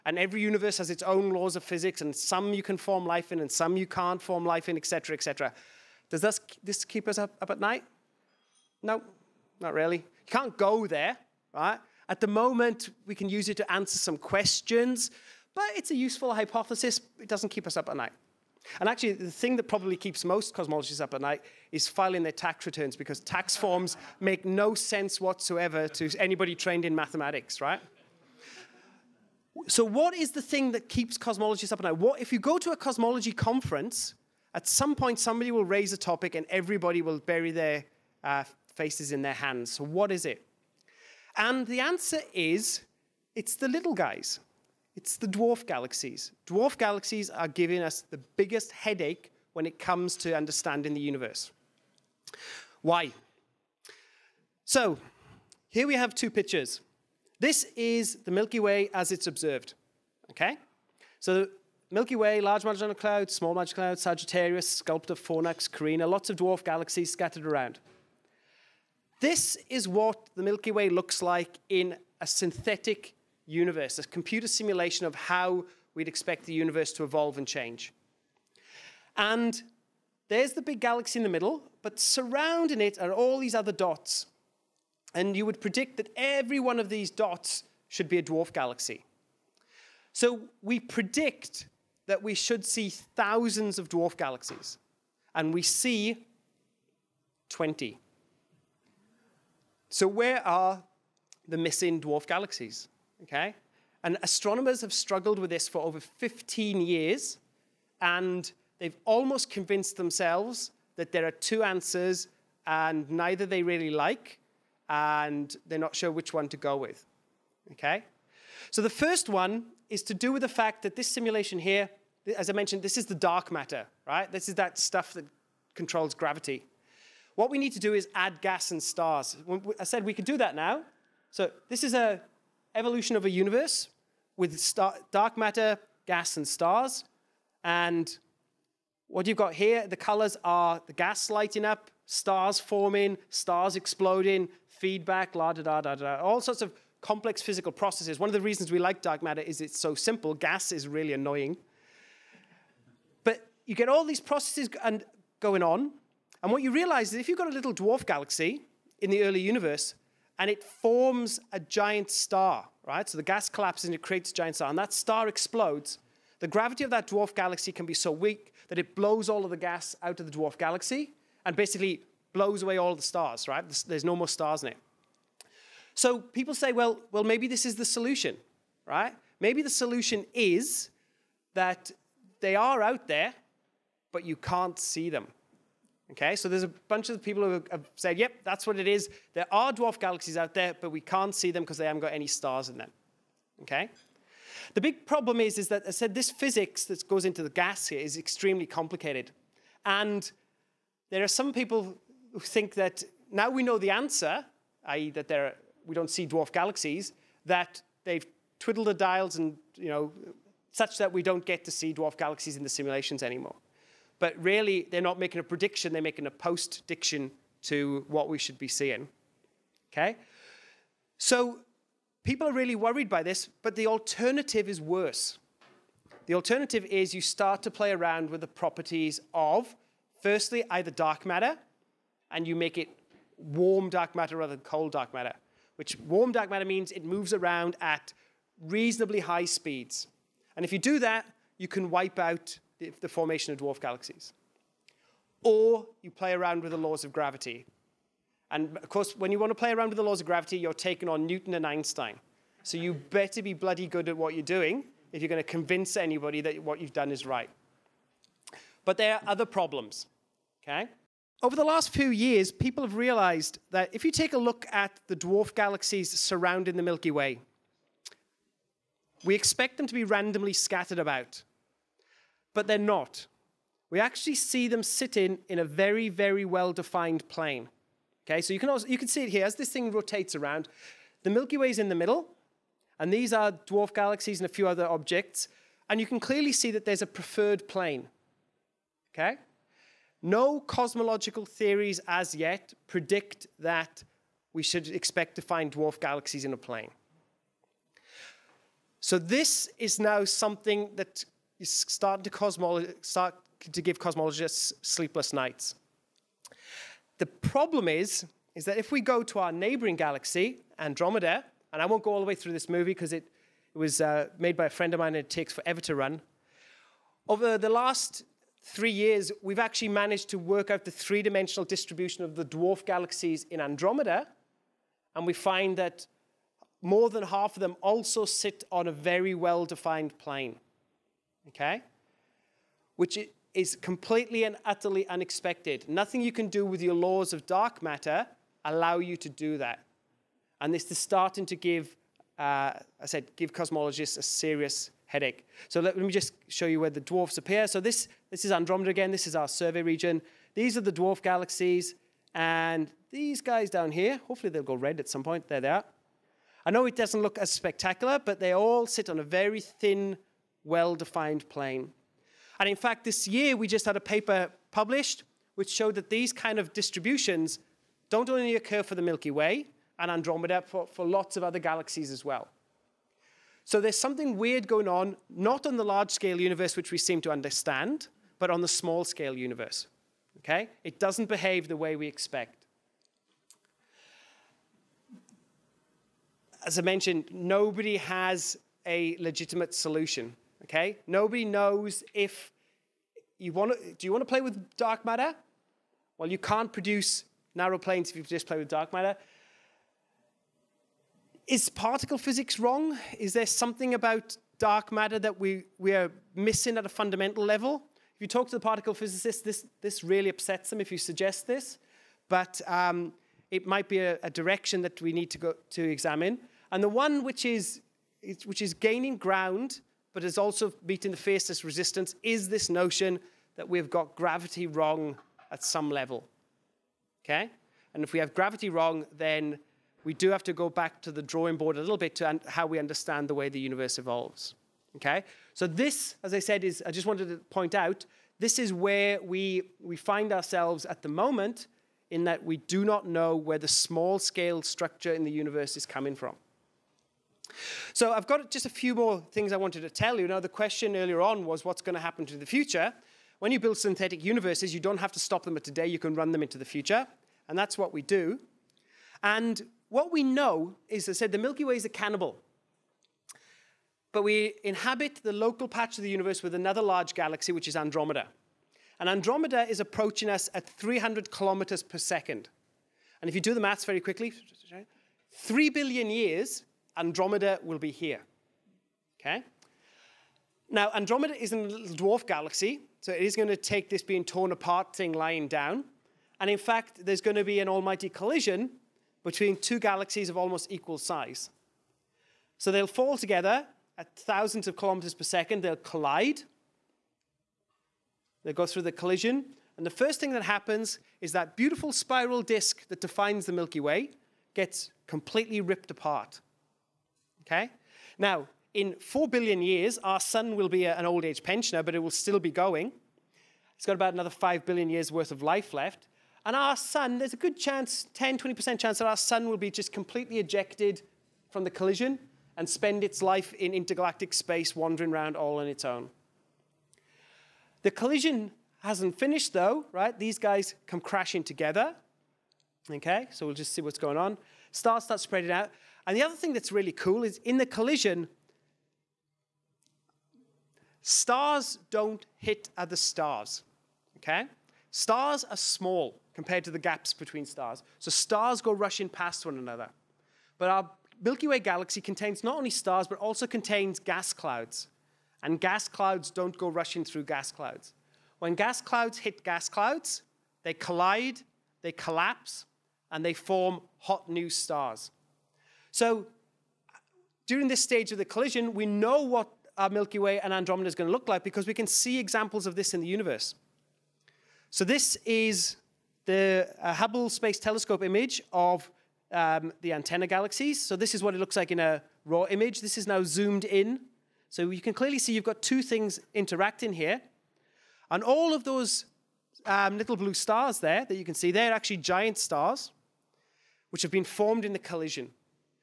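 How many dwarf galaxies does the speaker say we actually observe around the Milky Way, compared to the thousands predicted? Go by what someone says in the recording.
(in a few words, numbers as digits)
20.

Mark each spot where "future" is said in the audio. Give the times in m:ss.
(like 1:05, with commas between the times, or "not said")
7:32, 7:36.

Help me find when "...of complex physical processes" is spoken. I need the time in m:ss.
2:26.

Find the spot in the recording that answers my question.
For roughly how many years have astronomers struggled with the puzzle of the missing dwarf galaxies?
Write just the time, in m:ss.
1:45.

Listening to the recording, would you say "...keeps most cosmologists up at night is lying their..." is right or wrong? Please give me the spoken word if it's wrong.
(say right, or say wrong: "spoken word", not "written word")
wrong: "filing", not "lying".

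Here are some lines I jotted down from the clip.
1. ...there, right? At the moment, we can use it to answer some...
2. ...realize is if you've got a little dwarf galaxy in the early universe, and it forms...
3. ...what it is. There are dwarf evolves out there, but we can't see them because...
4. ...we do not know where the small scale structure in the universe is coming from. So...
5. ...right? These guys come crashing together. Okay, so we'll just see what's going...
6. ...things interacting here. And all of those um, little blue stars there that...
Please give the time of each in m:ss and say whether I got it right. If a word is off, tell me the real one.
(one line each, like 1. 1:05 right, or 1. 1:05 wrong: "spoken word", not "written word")
1. 0:10 right
2. 2:36 right
3. 3:08 wrong: "galaxies", not "evolves"
4. 7:22 right
5. 8:49 right
6. 9:45 right.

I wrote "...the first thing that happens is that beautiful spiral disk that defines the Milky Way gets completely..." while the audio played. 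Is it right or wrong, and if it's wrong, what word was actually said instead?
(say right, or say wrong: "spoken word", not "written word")
right.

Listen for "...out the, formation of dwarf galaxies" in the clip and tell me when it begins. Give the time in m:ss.
4:02.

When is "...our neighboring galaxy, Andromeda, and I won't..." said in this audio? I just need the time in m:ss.
5:09.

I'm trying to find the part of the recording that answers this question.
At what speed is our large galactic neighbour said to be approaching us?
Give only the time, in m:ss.
7:50.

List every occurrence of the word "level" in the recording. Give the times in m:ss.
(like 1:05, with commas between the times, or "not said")
6:47, 7:05.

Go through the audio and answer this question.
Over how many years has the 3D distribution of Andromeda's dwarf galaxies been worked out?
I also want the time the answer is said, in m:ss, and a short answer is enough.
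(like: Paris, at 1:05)
3 years, at 5:17.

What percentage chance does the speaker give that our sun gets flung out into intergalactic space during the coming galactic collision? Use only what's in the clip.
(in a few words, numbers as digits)
10-20%.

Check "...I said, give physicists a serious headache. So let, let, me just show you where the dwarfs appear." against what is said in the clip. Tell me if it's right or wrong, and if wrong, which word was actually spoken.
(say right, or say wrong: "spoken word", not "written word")
wrong: "cosmologists", not "physicists".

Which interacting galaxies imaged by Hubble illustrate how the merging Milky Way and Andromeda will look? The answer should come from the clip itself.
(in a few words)
The Antenna galaxies.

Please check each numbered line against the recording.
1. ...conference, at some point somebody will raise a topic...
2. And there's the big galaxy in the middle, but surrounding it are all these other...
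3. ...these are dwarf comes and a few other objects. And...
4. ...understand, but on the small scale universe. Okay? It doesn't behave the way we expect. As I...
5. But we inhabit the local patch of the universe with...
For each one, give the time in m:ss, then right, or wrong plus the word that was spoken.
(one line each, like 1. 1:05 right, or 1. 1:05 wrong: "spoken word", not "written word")
1. 0:33 right
2. 1:19 right
3. 4:43 wrong: "galaxies", not "comes"
4. 6:17 right
5. 7:44 right.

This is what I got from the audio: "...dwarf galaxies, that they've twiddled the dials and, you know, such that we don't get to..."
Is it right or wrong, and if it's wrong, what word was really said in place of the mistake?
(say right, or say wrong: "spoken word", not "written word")
right.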